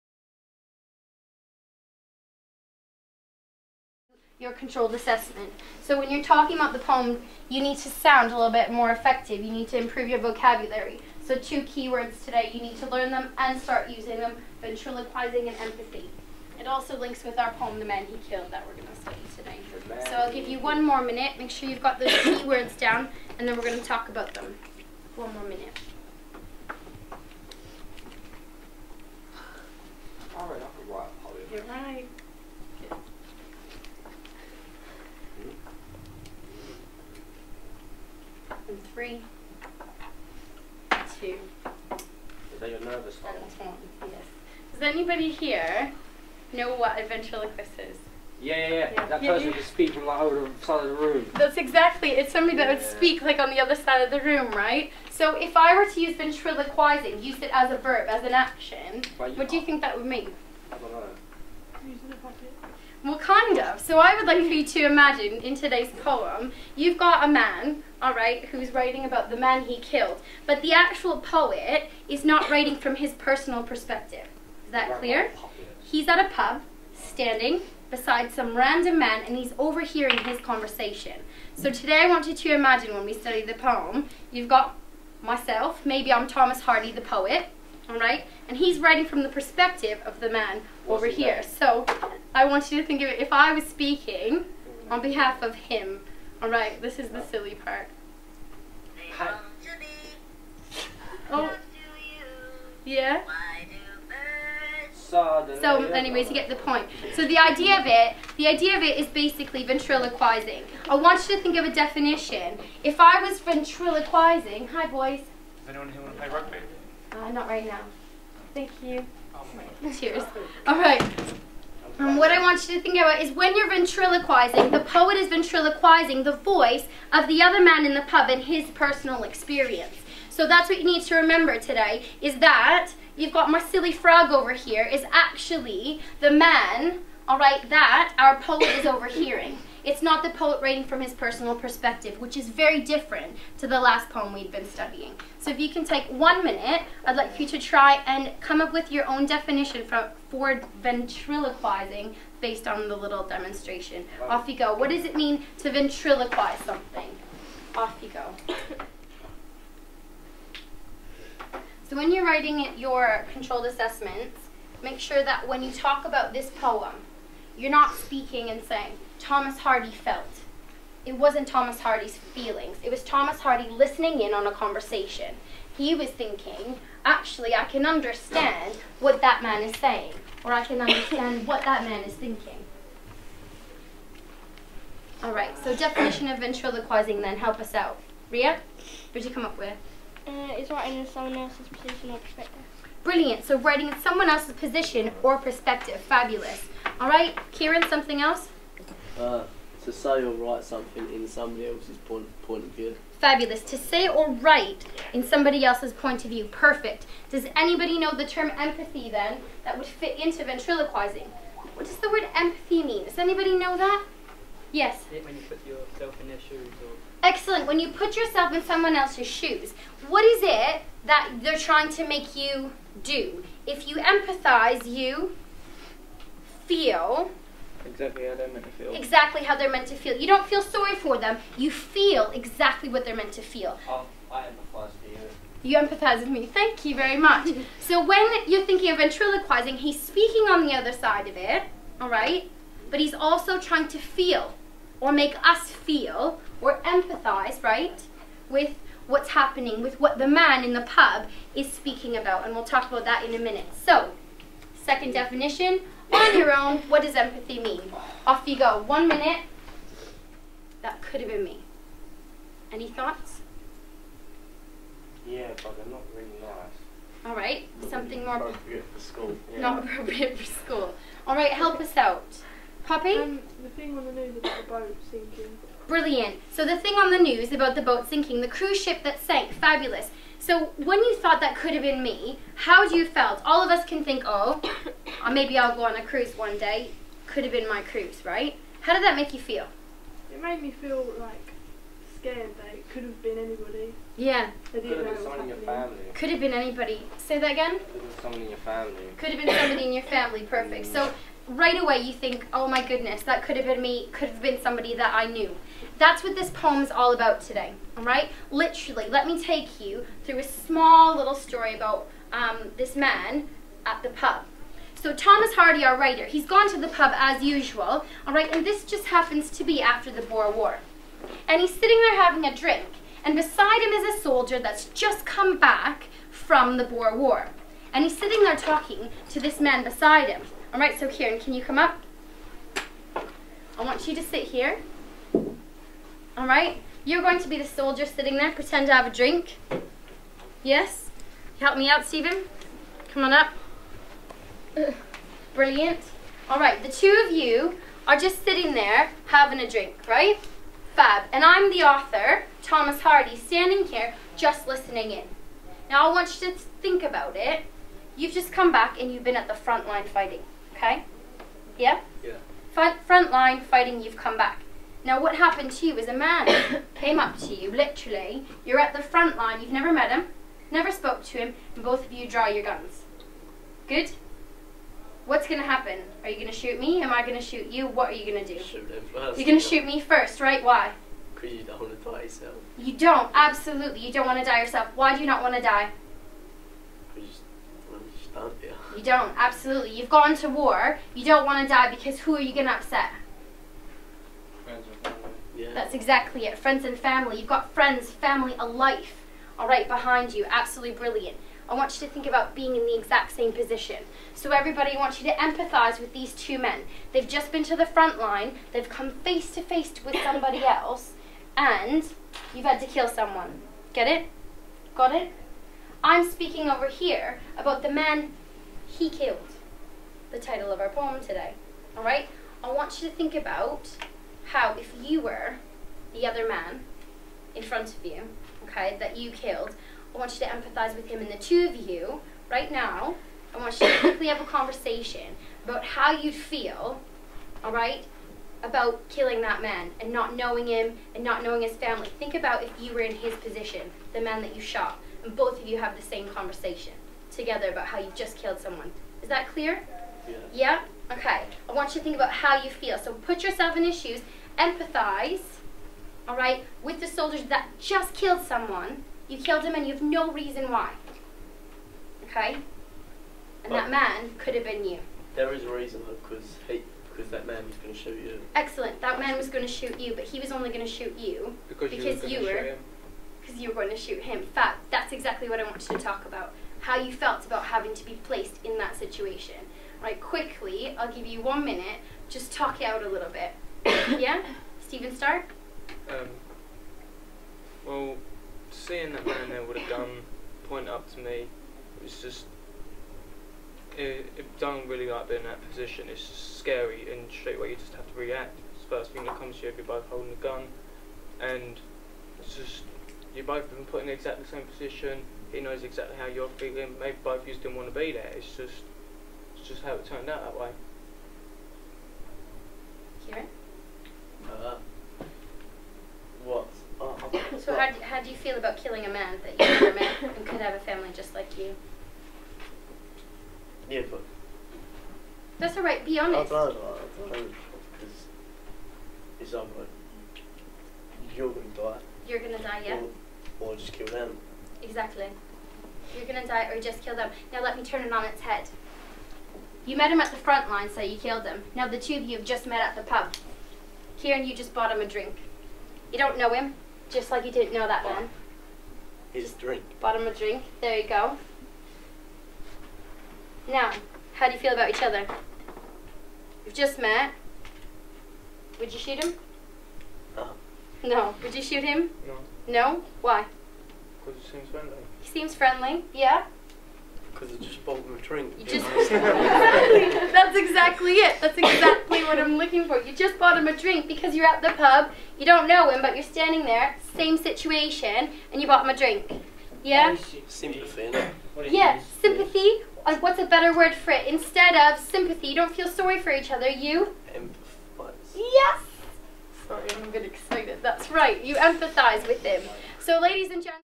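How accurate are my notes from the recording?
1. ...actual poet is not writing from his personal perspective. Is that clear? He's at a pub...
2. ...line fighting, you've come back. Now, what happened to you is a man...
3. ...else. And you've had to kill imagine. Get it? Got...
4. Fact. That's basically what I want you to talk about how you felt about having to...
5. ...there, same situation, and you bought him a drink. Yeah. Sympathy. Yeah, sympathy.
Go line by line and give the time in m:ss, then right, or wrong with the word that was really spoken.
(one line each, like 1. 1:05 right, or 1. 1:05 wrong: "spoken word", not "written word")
1. 1:10 right
2. 6:03 right
3. 6:50 wrong: "someone", not "imagine"
4. 7:54 wrong: "exactly", not "basically"
5. 9:36 right.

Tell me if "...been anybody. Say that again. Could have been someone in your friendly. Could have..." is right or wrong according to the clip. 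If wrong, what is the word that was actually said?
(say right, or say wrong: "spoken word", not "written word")
wrong: "family", not "friendly".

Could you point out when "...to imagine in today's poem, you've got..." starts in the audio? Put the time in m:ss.
1:04.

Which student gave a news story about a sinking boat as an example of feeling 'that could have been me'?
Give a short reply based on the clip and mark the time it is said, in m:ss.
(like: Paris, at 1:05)
Poppy, at 4:32.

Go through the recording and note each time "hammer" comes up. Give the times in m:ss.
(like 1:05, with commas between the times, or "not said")
not said.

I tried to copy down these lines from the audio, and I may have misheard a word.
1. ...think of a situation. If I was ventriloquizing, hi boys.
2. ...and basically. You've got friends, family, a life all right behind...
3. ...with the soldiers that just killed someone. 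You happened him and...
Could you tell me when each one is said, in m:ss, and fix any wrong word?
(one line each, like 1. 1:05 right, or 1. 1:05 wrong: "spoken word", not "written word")
1. 1:51 wrong: "definition", not "situation"
2. 6:36 wrong: "family", not "basically"
3. 7:36 wrong: "killed", not "happened".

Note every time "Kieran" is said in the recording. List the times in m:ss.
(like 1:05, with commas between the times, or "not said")
3:17, 5:31, 9:04.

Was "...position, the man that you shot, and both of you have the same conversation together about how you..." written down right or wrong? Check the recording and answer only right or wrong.
right.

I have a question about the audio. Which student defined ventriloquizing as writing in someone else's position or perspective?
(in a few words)
Ria.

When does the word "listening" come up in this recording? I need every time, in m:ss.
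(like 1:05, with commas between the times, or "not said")
2:53, 5:54.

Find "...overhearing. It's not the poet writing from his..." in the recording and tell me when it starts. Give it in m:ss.
2:18.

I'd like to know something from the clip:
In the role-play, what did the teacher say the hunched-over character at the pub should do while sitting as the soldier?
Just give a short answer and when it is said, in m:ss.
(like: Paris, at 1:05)
have a drink, at 5:38.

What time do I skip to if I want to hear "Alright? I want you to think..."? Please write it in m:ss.
7:01.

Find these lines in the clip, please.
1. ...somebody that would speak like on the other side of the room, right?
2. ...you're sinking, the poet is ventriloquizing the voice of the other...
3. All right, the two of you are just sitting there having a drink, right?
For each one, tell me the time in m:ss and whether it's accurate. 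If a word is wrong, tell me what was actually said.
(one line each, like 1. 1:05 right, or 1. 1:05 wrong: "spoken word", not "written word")
1. 0:52 right
2. 2:03 wrong: "ventriloquizing", not "sinking"
3. 5:46 right.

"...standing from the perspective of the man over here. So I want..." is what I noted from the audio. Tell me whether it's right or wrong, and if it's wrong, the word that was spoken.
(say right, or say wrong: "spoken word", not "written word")
wrong: "writing", not "standing".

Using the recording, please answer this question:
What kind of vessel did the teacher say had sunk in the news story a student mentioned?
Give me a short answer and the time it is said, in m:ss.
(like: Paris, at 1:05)
cruise ship, at 4:38.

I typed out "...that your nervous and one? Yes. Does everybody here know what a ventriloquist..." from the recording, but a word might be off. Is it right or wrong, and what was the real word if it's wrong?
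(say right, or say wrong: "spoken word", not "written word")
wrong: "anybody", not "everybody".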